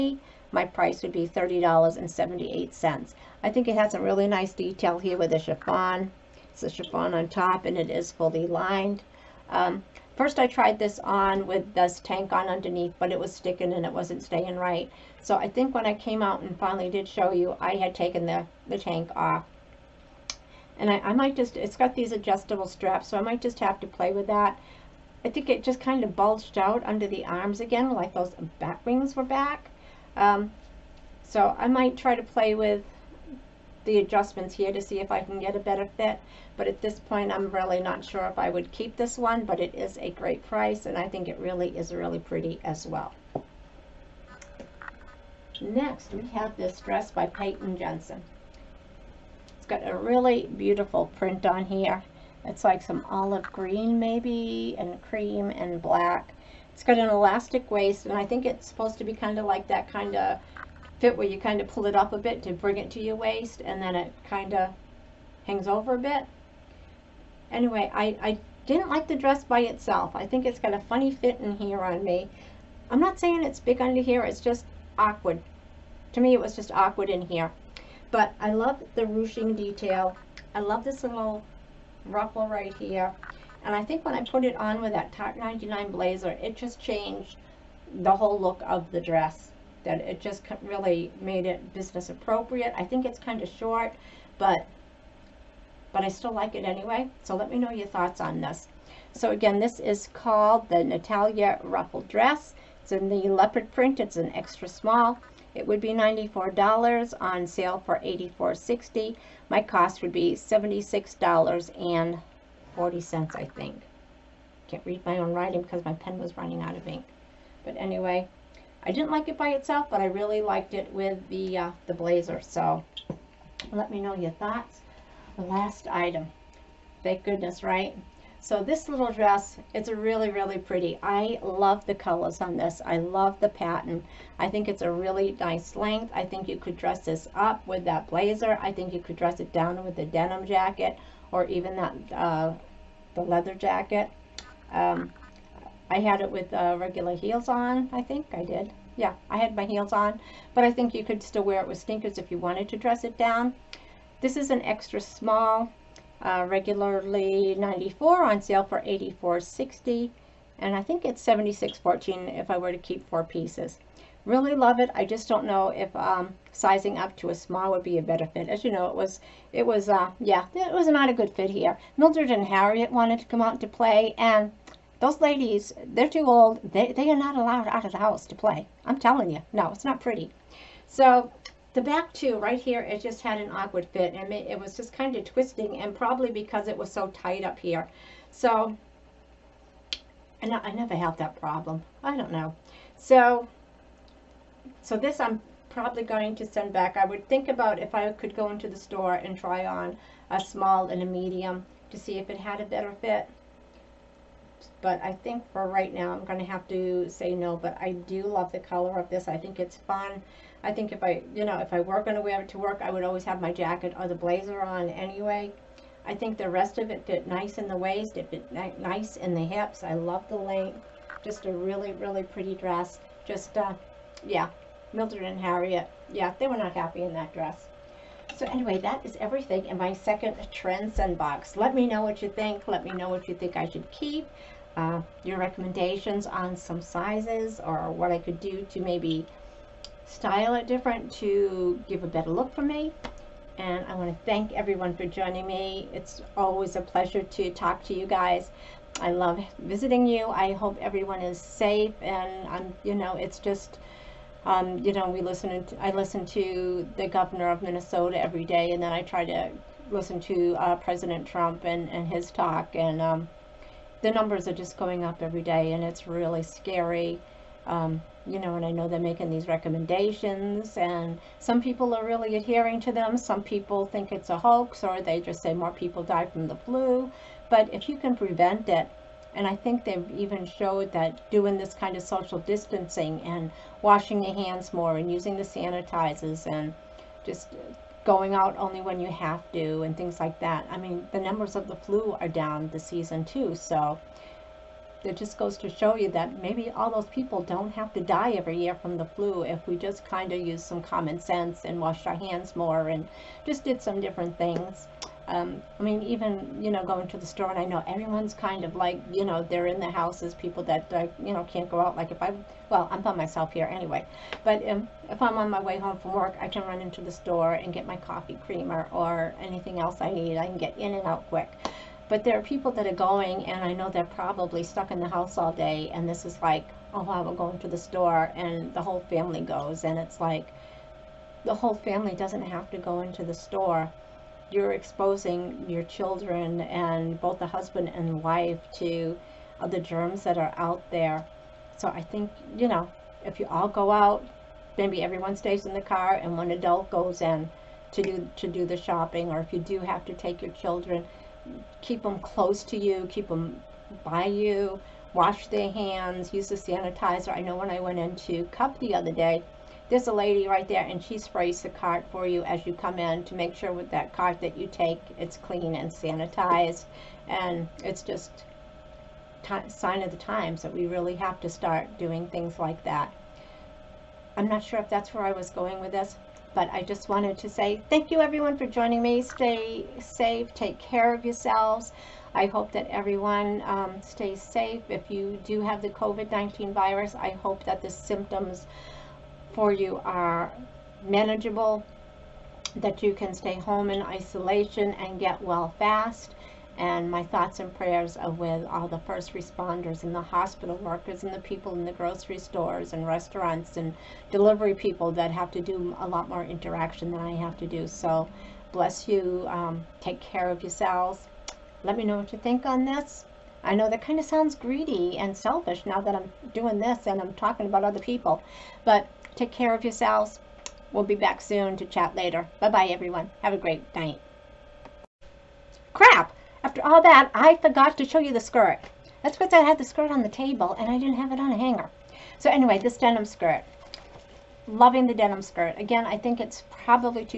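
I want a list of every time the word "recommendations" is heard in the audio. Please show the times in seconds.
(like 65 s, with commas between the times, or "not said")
235 s, 269 s.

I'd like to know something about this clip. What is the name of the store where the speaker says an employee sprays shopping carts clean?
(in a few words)
Cup.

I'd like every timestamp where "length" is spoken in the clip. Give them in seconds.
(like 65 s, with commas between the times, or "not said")
135 s, 220 s.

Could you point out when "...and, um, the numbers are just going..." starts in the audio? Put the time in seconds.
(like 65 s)
262 s.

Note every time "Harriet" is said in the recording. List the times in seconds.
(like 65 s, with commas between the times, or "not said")
172 s, 225 s.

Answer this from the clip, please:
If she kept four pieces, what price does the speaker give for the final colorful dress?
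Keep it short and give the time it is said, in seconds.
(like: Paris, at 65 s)
$76.14, at 161 s.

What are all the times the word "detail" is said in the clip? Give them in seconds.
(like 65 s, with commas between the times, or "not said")
4 s, 79 s.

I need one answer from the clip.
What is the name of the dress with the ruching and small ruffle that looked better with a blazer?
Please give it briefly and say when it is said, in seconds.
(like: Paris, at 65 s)
Natalia Ruffle Dress, at 100 s.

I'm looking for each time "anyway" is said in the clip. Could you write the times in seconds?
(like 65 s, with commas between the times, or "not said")
67 s, 96 s, 117 s, 214 s, 228 s, 313 s, 432 s.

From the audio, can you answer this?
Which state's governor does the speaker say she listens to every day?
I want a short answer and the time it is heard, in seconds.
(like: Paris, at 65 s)
Minnesota, at 257 s.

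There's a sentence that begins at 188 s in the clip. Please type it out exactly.
So and I, I never had that problem.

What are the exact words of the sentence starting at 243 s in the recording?
And I want to thank everyone for joining me.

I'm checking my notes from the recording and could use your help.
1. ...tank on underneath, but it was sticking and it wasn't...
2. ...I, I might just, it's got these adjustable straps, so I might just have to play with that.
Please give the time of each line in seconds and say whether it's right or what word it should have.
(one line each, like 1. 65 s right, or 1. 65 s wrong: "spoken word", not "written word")
1. 11 s right
2. 20 s right.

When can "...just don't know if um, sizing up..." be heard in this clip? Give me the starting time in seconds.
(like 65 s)
165 s.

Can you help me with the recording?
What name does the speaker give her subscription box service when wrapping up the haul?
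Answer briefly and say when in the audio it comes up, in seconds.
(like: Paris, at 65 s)
Trendsend, at 230 s.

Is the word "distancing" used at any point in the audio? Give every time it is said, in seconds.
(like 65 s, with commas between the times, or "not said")
282 s.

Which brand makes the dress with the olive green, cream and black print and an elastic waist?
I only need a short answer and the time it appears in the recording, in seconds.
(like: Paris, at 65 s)
Peyton Jensen, at 47 s.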